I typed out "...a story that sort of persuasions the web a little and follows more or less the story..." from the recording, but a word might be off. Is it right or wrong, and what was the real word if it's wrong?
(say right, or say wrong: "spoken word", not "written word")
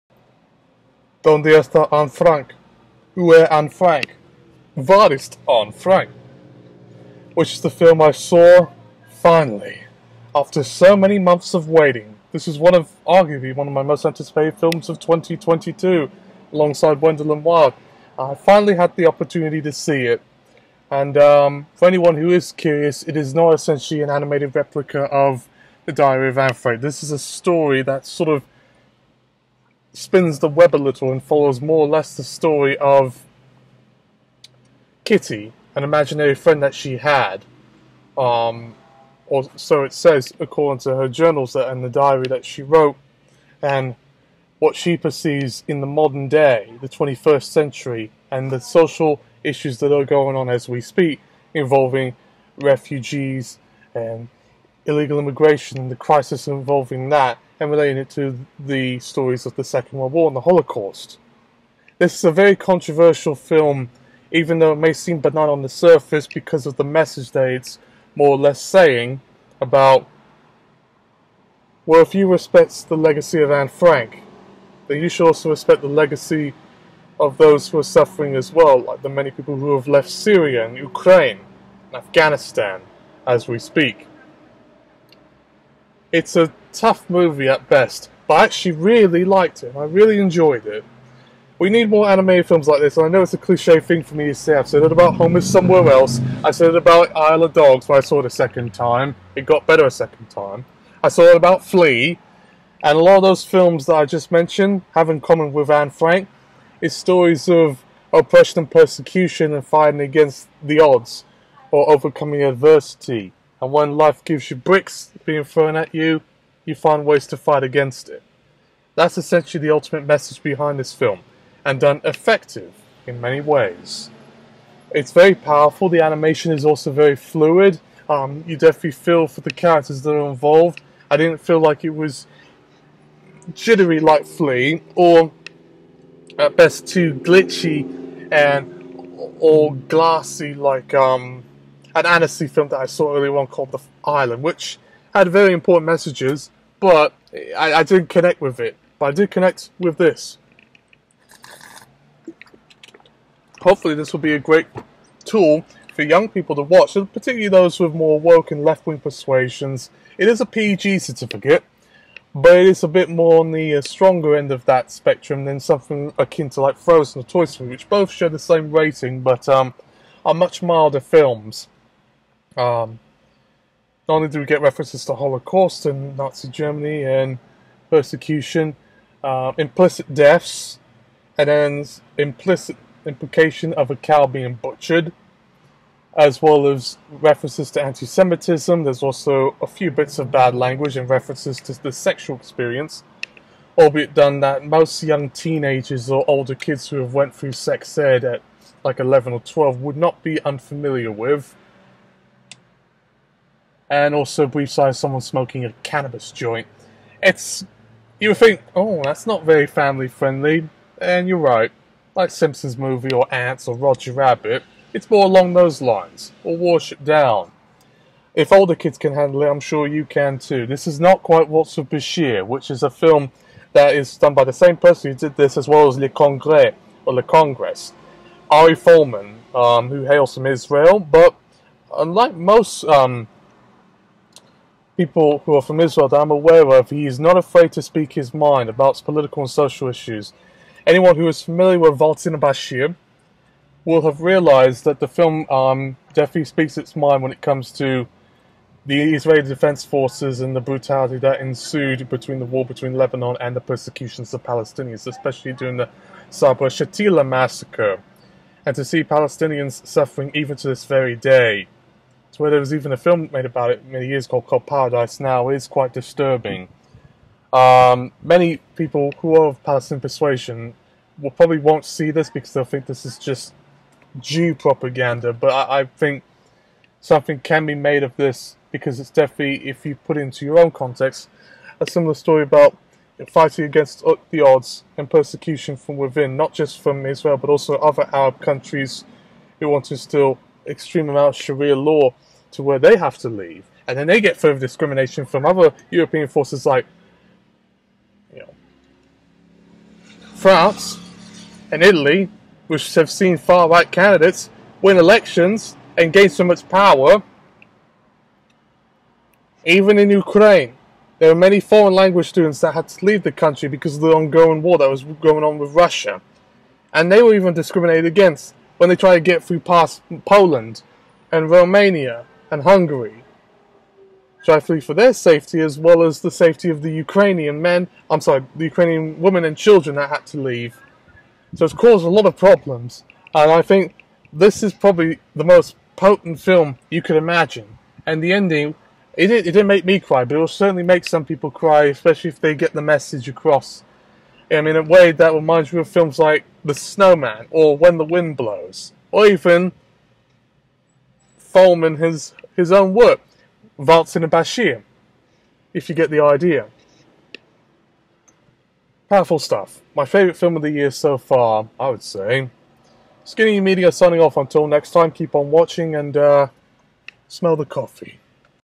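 wrong: "spins", not "persuasions".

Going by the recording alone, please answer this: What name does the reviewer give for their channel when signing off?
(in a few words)
Skinny Media.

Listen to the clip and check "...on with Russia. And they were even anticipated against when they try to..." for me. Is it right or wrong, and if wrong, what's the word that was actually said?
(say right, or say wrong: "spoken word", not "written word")
wrong: "discriminated", not "anticipated".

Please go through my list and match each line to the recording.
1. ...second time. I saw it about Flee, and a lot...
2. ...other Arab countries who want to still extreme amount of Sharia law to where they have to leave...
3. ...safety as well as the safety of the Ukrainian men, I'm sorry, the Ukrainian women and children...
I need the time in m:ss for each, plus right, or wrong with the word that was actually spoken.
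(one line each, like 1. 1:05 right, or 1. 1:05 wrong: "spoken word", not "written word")
1. 1:39 right
2. 4:47 right
3. 5:25 right.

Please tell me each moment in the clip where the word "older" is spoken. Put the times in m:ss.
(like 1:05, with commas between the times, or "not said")
3:16, 3:38.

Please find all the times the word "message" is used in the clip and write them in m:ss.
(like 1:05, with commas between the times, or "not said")
1:06, 2:00, 2:25, 5:42.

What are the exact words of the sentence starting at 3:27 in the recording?
It's you would think, oh, that's not very family friendly, and you're right.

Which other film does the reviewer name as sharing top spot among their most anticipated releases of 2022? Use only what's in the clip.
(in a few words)
Wendell Wild.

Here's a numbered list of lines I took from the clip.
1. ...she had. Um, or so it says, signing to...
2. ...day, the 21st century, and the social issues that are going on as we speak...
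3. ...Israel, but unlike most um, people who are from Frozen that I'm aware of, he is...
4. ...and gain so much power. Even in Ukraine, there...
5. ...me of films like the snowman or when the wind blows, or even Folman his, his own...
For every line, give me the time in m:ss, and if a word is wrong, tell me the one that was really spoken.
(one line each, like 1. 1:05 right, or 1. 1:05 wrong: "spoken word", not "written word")
1. 0:36 wrong: "according", not "signing"
2. 0:46 right
3. 3:50 wrong: "Israel", not "Frozen"
4. 5:05 right
5. 5:45 right.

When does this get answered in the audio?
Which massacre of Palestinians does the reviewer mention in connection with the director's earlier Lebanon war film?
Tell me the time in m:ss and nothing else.
4:16.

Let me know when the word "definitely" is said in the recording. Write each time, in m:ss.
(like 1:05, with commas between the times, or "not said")
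2:08, 4:06, 4:39.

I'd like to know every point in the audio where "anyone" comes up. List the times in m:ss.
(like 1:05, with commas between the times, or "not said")
0:21, 4:00.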